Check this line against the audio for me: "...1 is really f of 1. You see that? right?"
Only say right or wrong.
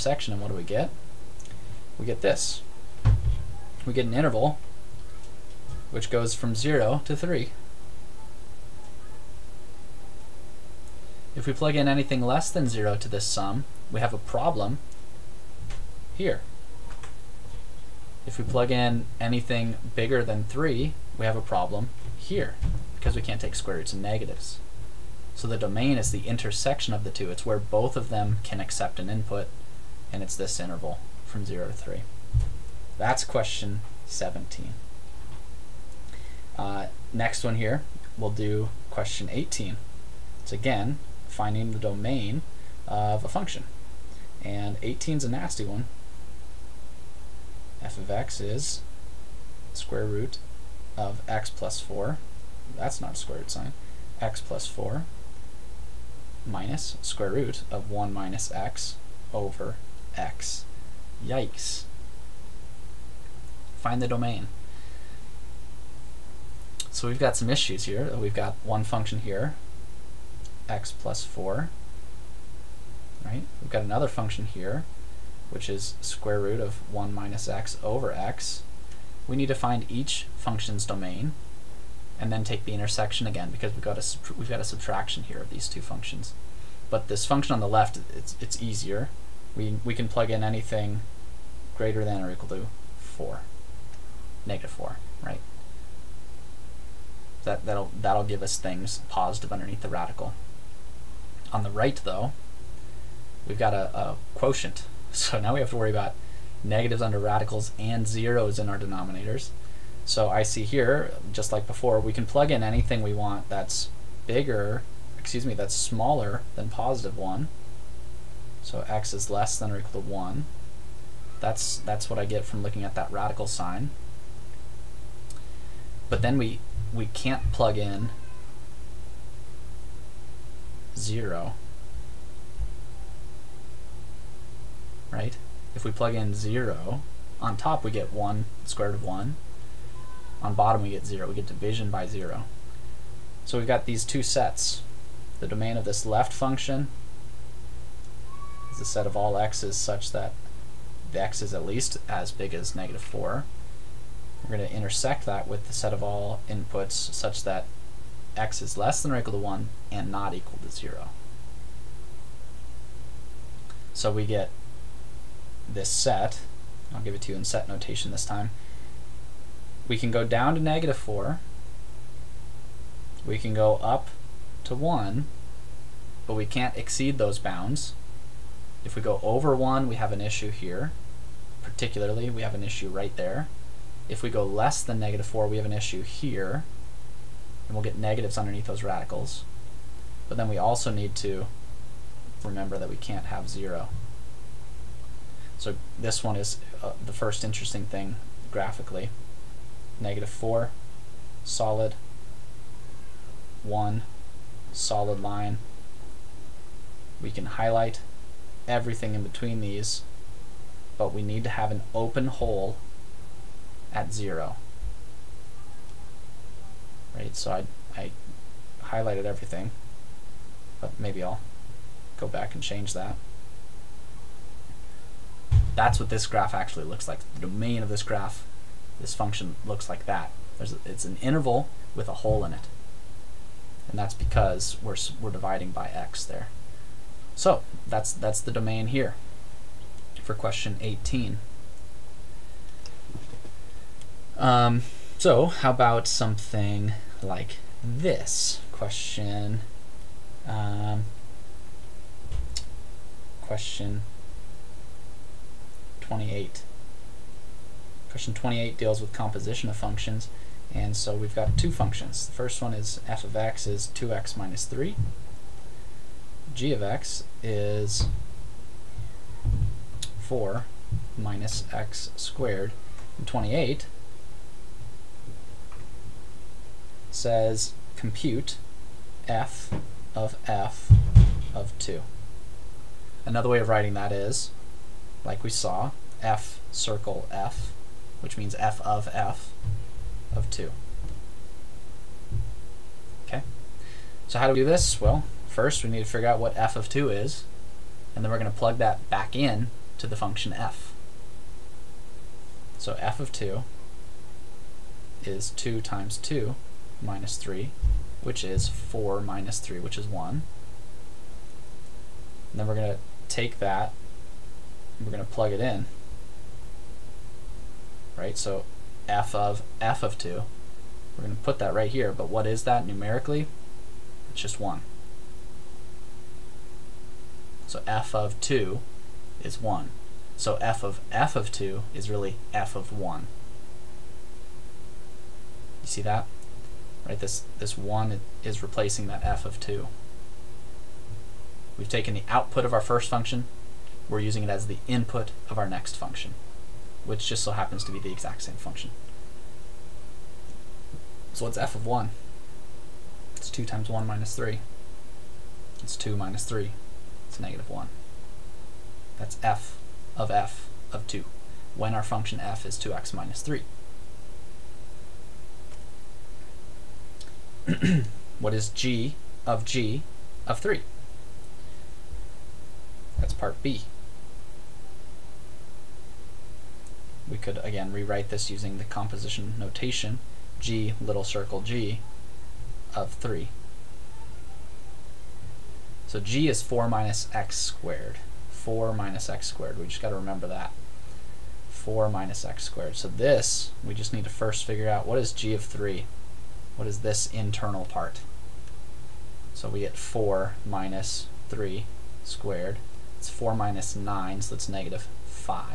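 wrong.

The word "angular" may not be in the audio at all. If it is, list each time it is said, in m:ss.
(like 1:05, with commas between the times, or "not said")
not said.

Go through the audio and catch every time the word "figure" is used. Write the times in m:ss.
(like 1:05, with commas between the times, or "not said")
4:56, 6:34.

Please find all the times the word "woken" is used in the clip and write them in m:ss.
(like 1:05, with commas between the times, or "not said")
not said.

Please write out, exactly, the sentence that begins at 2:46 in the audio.
I'll give it to you in set notation this time.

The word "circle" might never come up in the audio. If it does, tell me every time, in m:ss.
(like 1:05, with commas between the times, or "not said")
4:46, 6:21.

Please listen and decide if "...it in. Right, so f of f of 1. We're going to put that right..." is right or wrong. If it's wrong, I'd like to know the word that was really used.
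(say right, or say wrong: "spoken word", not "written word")
wrong: "2", not "1".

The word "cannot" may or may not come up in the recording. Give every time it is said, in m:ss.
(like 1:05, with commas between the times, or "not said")
not said.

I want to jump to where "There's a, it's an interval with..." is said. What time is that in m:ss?
3:50.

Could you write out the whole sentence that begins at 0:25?
So the domain is the intersection of the two.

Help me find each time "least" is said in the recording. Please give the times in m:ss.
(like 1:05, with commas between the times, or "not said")
2:31.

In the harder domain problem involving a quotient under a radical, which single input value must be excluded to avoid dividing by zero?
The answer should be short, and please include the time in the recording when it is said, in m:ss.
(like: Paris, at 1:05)
0, at 2:06.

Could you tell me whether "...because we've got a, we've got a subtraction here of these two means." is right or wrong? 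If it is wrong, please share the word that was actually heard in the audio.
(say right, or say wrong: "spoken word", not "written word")
wrong: "functions", not "means".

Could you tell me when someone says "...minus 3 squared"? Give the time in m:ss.
6:40.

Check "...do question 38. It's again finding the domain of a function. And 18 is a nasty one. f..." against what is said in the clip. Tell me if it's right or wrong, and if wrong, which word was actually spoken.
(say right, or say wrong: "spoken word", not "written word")
wrong: "18", not "38".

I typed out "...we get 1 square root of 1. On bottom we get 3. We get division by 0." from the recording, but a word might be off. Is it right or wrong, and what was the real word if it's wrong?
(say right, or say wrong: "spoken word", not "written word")
wrong: "0", not "3".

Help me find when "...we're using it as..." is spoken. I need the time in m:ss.
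5:44.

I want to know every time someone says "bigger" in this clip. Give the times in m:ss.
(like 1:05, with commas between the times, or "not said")
0:19, 1:54.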